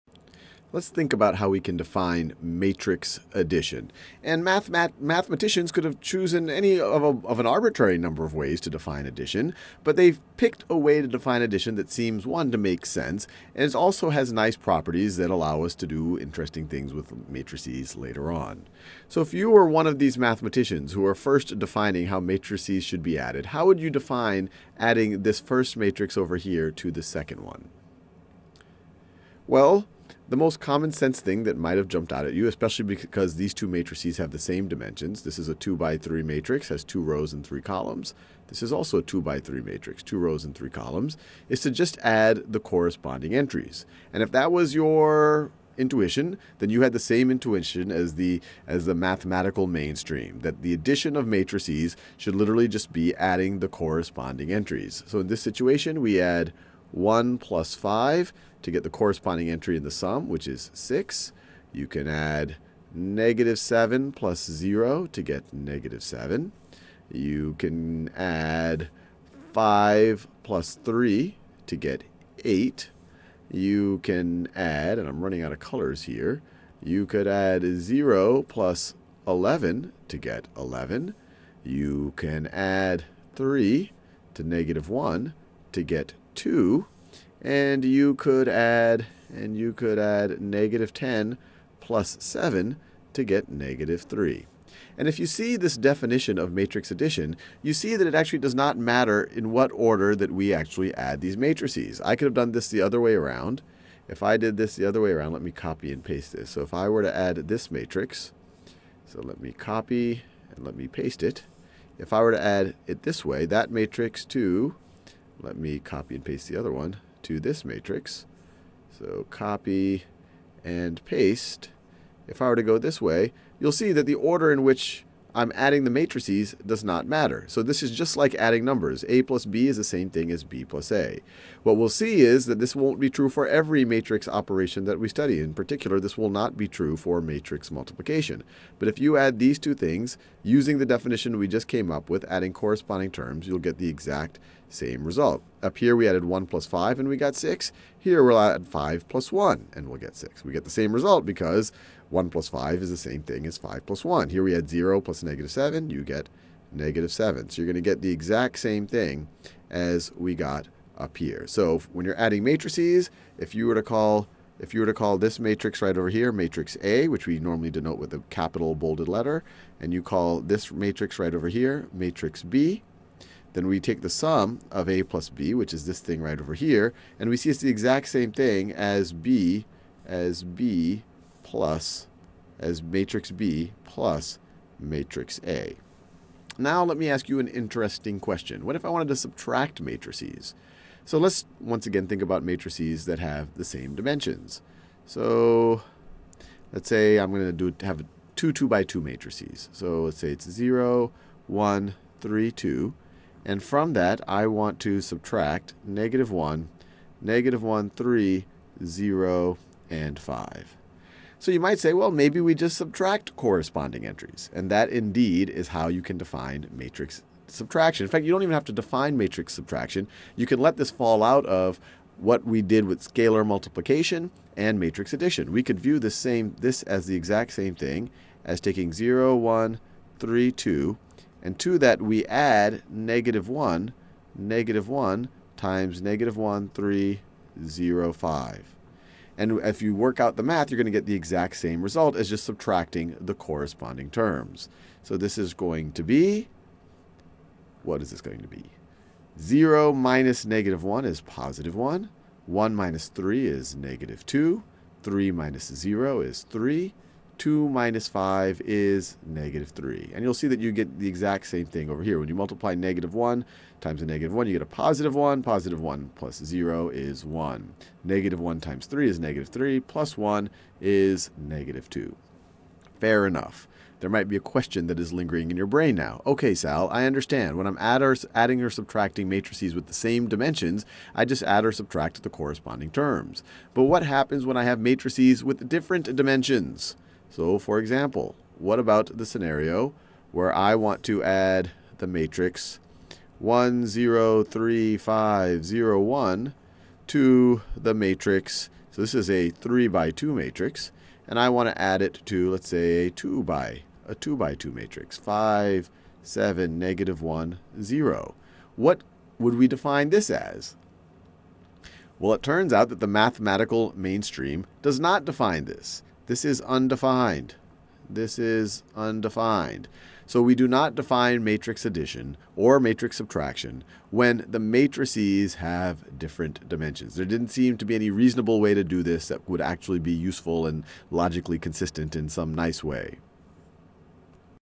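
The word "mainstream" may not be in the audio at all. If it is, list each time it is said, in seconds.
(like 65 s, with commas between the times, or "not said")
49 s, 313 s.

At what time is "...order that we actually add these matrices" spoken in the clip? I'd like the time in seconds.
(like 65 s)
99 s.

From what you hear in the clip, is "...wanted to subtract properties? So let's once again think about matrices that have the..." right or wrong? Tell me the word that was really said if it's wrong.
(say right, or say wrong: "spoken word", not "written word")
wrong: "matrices", not "properties".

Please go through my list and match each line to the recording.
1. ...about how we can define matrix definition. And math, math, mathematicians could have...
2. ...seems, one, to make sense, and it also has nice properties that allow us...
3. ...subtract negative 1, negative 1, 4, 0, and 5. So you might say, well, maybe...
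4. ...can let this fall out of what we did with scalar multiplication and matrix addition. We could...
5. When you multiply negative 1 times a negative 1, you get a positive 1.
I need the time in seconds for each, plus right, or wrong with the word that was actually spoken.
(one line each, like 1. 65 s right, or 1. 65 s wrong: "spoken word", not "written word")
1. 1 s wrong: "addition", not "definition"
2. 11 s right
3. 205 s wrong: "3", not "4"
4. 220 s right
5. 262 s right.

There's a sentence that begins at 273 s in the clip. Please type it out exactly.
There might be a question that is lingering in your brain now.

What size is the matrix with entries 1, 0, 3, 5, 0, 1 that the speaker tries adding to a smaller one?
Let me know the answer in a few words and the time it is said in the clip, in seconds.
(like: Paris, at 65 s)
3 by 2, at 299 s.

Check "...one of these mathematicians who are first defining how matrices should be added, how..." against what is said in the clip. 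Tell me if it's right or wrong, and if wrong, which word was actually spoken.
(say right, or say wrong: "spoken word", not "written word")
right.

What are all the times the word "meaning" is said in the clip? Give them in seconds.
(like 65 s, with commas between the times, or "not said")
not said.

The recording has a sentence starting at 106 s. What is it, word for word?
So if I were to add this matrix, so let me copy and let me paste it.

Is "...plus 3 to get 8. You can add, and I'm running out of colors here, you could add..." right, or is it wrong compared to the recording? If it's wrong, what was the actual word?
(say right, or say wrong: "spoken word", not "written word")
right.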